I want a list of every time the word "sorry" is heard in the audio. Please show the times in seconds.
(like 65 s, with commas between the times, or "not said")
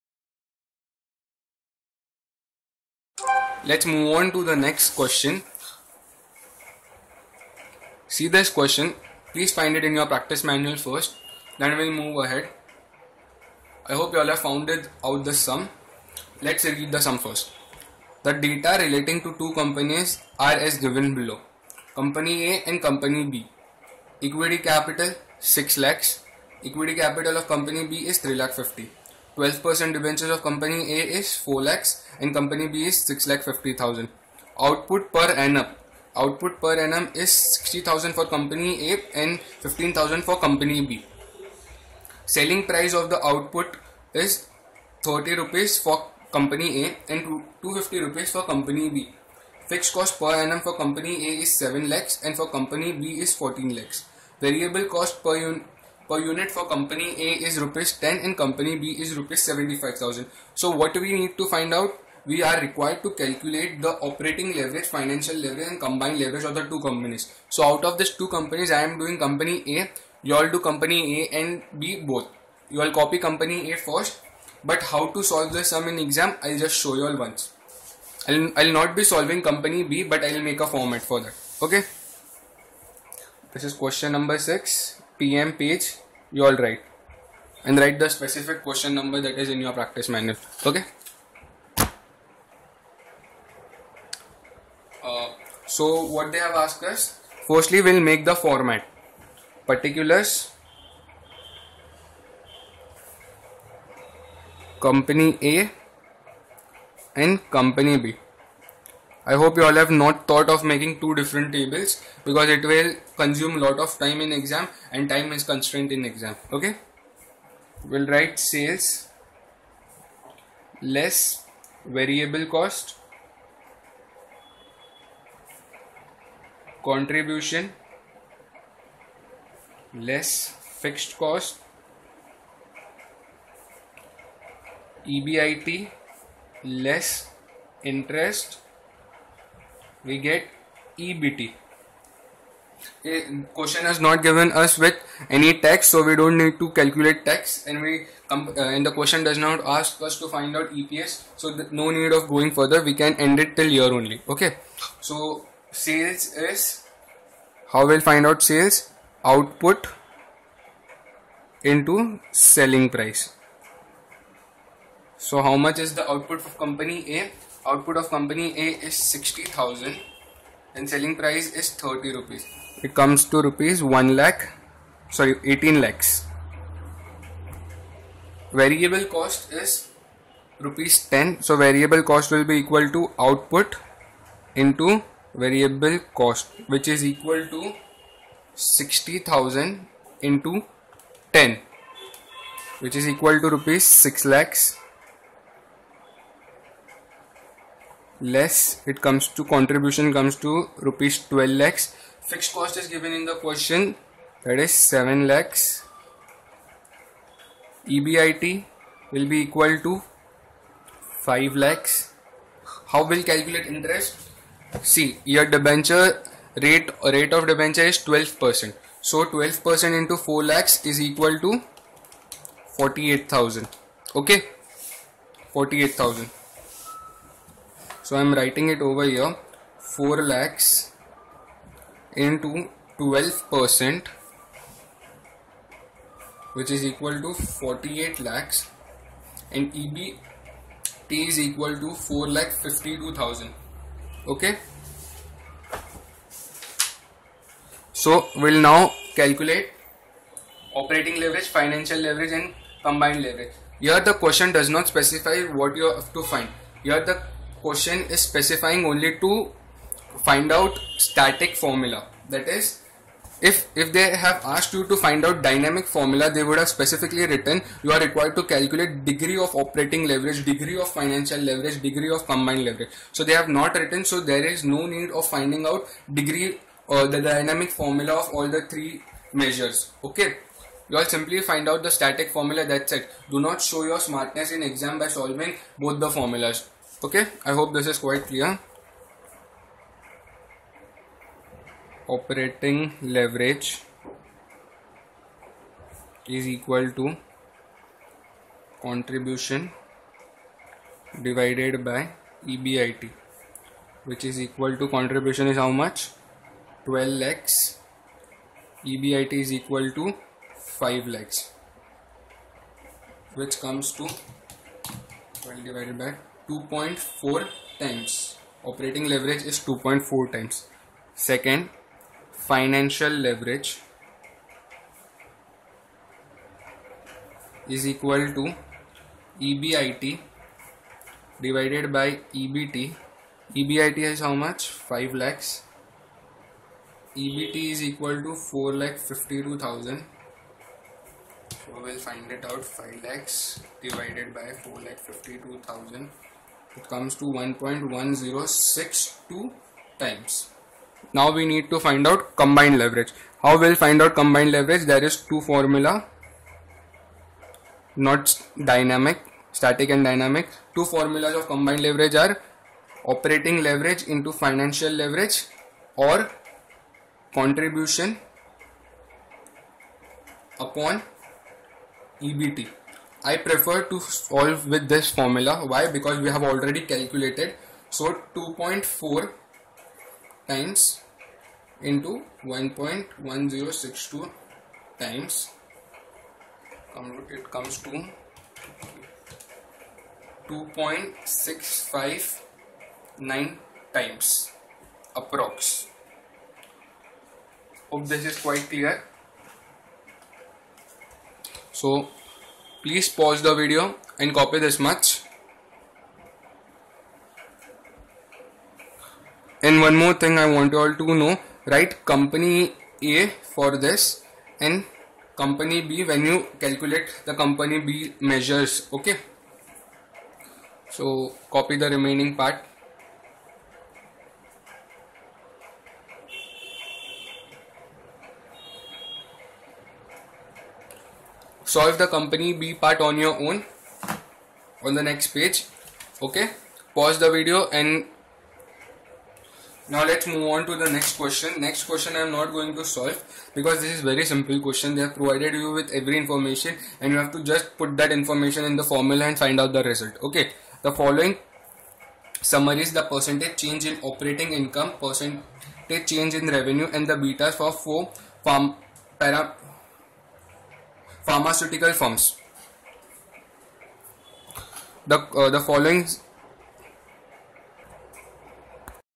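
175 s.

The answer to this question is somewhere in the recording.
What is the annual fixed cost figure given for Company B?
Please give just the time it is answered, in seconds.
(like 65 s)
53 s.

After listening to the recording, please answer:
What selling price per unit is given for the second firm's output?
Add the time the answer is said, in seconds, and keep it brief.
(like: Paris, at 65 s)
250 rupees, at 47 s.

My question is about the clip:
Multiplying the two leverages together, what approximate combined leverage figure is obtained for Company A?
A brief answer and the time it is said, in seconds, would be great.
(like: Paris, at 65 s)
2.659 times, at 390 s.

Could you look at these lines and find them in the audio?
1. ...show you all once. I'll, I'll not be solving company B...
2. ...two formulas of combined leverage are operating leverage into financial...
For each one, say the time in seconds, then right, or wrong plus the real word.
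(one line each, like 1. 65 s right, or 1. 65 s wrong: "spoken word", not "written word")
1. 76 s right
2. 360 s right.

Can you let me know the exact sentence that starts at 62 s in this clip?
We are required to calculate the operating leverage, financial leverage and combined leverage of the two companies.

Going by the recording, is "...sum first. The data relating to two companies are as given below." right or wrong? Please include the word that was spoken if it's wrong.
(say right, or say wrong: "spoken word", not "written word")
right.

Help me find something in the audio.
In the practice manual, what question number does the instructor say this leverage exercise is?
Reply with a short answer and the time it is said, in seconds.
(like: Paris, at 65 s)
6, at 83 s.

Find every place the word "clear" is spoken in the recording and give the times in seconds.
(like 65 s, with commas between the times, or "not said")
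288 s, 398 s.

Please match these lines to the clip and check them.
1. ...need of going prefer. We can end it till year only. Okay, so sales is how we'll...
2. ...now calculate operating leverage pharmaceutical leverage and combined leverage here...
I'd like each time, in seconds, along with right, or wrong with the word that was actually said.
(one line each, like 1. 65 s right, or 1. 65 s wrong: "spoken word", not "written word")
1. 151 s wrong: "further", not "prefer"
2. 248 s wrong: "financial", not "pharmaceutical".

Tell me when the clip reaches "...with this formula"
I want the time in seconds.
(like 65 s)
374 s.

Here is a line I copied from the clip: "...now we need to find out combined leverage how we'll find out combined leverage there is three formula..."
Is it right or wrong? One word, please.
wrong.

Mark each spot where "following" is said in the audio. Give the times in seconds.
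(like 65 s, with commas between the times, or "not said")
450 s, 465 s.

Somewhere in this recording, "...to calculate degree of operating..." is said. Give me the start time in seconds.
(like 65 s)
268 s.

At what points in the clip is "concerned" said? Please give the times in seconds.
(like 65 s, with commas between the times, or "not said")
not said.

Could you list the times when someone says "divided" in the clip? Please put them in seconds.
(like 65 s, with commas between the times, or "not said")
301 s, 315 s, 331 s, 343 s.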